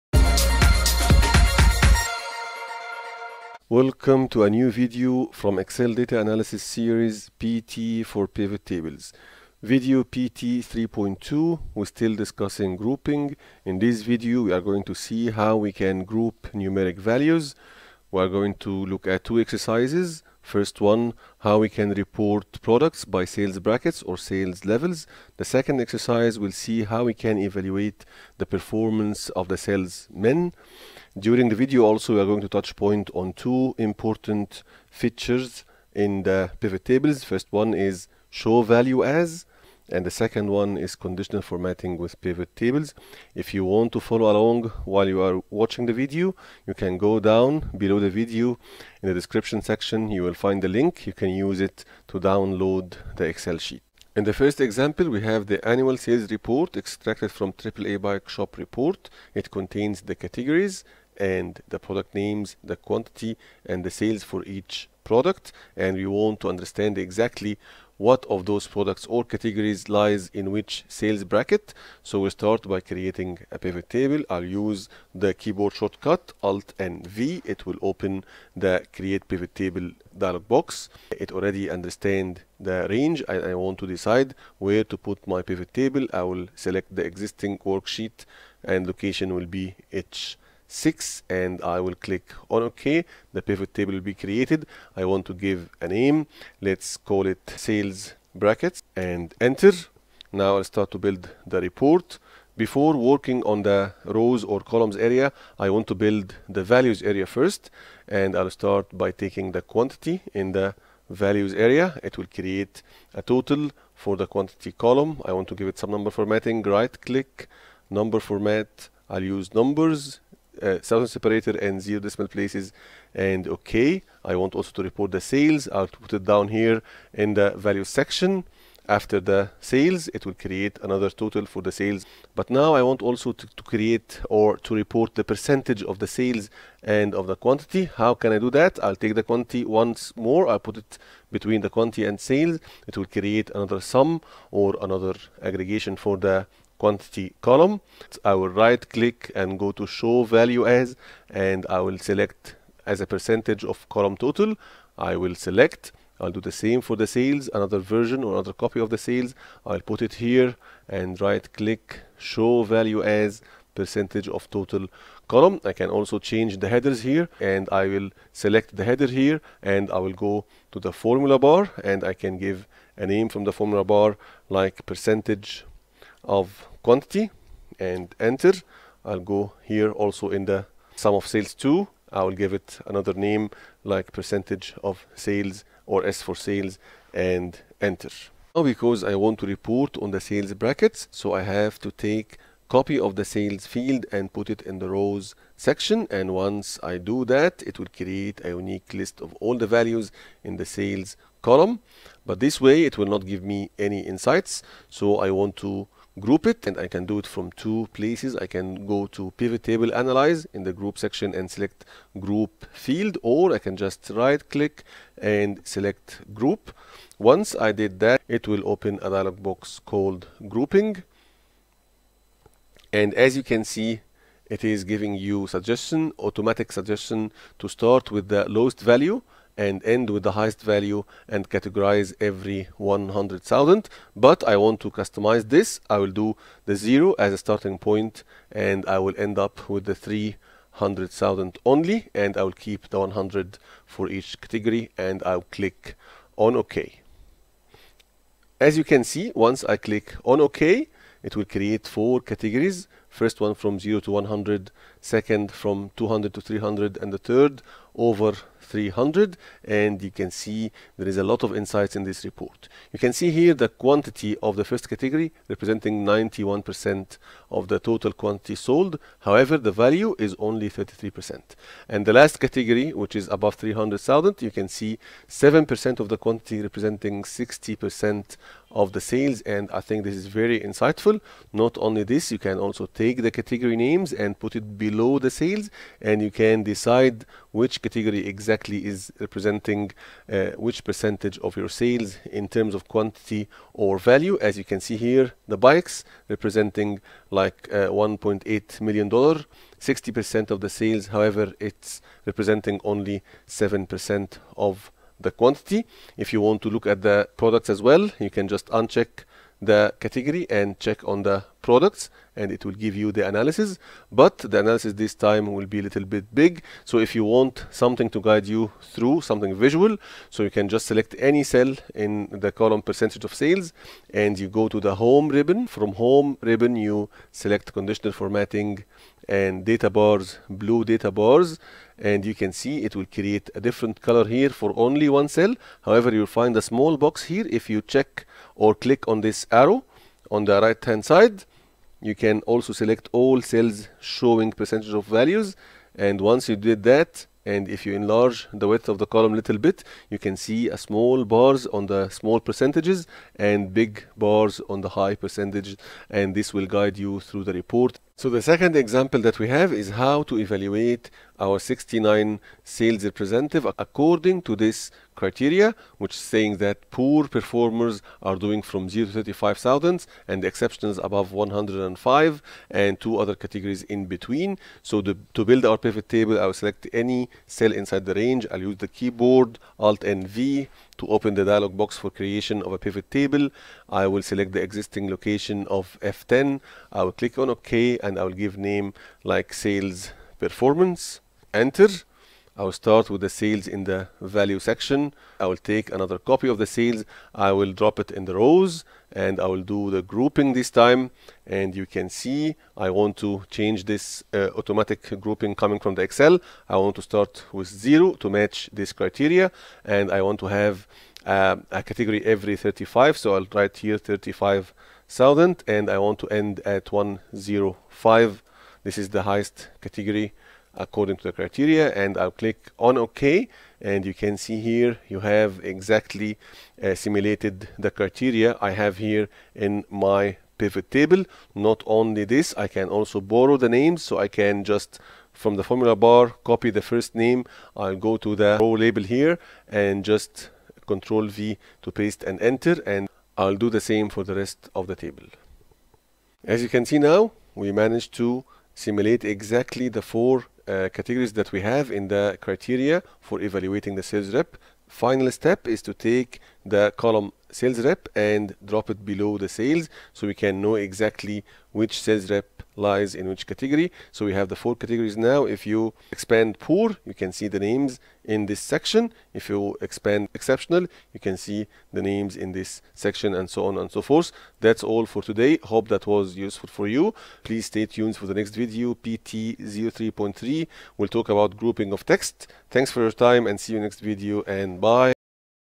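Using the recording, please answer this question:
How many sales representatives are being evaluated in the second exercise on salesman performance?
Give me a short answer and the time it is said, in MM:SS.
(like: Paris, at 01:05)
69, at 06:01.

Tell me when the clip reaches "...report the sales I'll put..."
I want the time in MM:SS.
02:04.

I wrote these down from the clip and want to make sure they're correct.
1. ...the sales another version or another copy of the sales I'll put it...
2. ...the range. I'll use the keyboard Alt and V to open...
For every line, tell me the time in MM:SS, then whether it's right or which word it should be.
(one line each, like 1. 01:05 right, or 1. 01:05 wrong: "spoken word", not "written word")
1. 02:37 right
2. 06:18 right.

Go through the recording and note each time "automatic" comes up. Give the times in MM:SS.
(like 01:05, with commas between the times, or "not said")
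03:46, 06:44.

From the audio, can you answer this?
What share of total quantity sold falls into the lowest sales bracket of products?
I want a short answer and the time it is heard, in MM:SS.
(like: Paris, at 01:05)
91%, at 04:26.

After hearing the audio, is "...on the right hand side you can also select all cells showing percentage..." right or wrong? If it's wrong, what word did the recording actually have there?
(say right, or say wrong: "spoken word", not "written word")
right.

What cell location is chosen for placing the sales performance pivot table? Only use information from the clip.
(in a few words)
F10.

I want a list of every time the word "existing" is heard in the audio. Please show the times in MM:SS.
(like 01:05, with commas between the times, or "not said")
01:27, 06:24.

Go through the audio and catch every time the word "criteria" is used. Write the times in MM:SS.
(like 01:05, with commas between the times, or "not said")
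06:05, 06:48, 07:01, 07:07, 07:32.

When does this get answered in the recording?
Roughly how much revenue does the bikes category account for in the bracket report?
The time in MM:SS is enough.
04:57.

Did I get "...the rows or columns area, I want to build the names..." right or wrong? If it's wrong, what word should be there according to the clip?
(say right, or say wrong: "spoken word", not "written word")
wrong: "values", not "names".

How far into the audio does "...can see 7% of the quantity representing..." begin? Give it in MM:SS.
04:34.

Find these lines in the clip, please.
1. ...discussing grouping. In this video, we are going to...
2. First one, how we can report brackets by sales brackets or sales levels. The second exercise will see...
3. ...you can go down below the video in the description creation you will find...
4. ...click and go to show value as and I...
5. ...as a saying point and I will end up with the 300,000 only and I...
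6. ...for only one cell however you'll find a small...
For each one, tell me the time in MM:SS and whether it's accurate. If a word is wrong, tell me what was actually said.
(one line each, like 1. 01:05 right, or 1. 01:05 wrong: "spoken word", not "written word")
1. 00:12 right
2. 00:20 wrong: "products", not "brackets"
3. 00:46 wrong: "section", not "creation"
4. 02:28 right
5. 03:57 wrong: "starting", not "saying"
6. 05:34 right.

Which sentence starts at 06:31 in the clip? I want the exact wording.
Enter I will start with the sales in the value section.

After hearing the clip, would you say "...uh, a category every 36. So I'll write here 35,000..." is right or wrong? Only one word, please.
wrong.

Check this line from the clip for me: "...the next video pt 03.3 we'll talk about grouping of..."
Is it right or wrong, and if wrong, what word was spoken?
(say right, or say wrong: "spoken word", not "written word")
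right.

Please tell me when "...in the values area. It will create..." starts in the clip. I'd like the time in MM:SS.
01:50.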